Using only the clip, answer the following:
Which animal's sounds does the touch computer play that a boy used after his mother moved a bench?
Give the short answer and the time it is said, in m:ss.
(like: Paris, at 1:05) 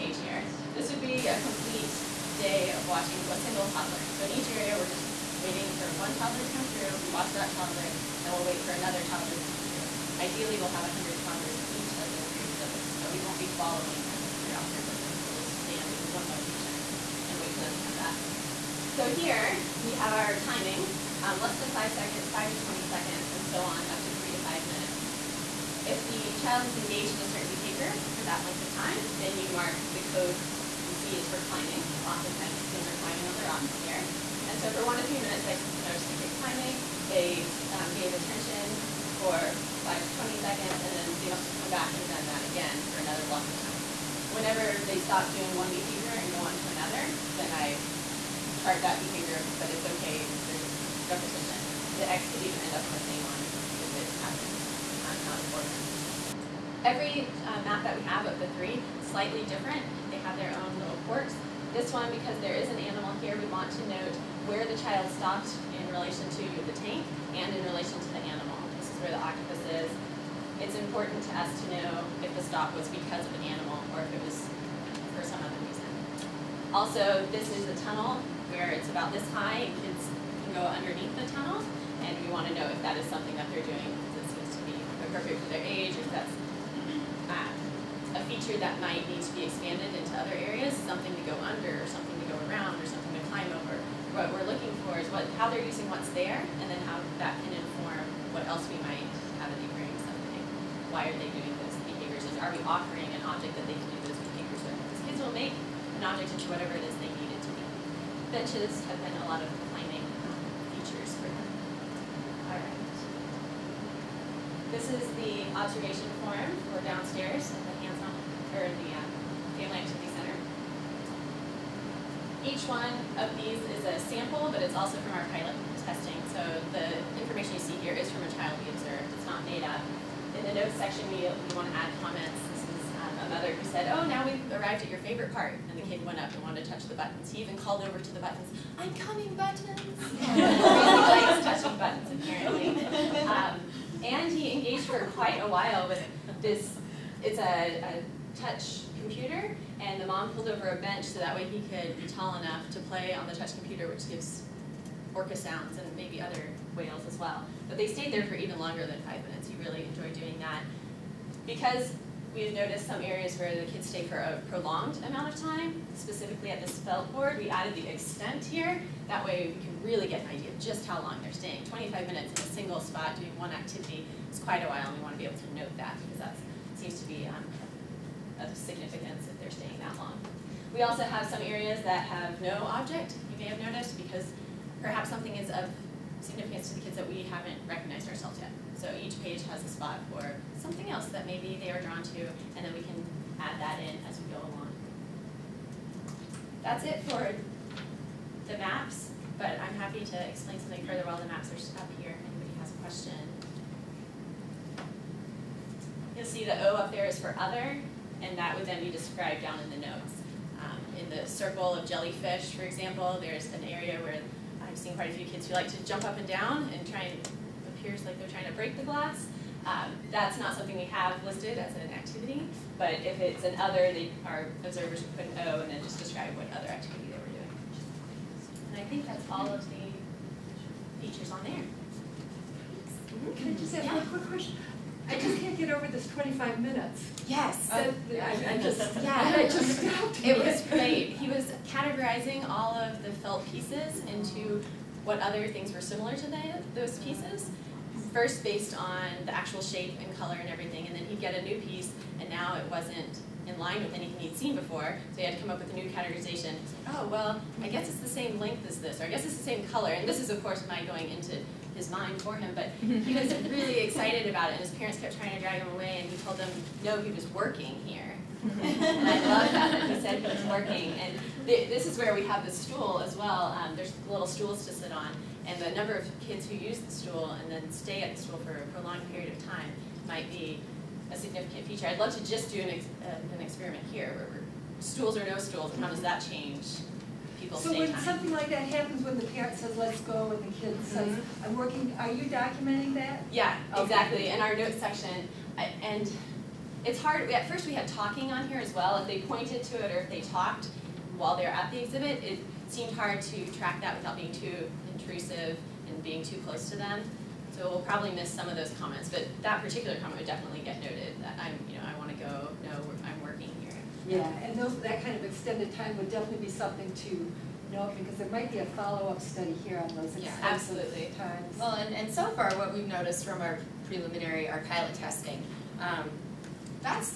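Orca, at 2:35.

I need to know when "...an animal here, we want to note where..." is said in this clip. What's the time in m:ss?
1:02.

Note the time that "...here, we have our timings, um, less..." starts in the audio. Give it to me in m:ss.
0:19.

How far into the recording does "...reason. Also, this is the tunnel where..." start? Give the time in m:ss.
1:15.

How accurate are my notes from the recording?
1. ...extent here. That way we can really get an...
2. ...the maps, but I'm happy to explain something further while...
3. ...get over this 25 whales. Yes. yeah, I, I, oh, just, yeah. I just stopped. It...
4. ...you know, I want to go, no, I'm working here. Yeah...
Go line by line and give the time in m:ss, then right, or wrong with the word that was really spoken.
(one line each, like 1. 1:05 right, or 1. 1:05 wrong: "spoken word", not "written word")
1. 2:47 right
2. 3:18 right
3. 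3:55 wrong: "minutes", not "whales"
4. 5:11 right.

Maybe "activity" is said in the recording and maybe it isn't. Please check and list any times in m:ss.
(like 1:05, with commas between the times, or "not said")
1:59, 2:53, 3:41, 3:46.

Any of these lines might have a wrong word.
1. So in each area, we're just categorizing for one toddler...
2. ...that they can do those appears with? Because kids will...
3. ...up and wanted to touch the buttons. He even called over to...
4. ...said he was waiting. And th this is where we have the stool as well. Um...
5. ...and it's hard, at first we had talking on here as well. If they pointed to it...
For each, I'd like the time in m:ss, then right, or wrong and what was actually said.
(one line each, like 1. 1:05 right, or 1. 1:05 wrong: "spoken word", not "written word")
1. 0:04 wrong: "waiting", not "categorizing"
2. 1:43 wrong: "behaviors", not "appears"
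3. 2:16 right
4. 4:29 wrong: "working", not "waiting"
5. 4:55 right.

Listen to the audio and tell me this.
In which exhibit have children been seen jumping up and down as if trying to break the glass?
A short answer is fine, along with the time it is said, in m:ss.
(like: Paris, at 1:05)
Circle of jellyfish, at 3:31.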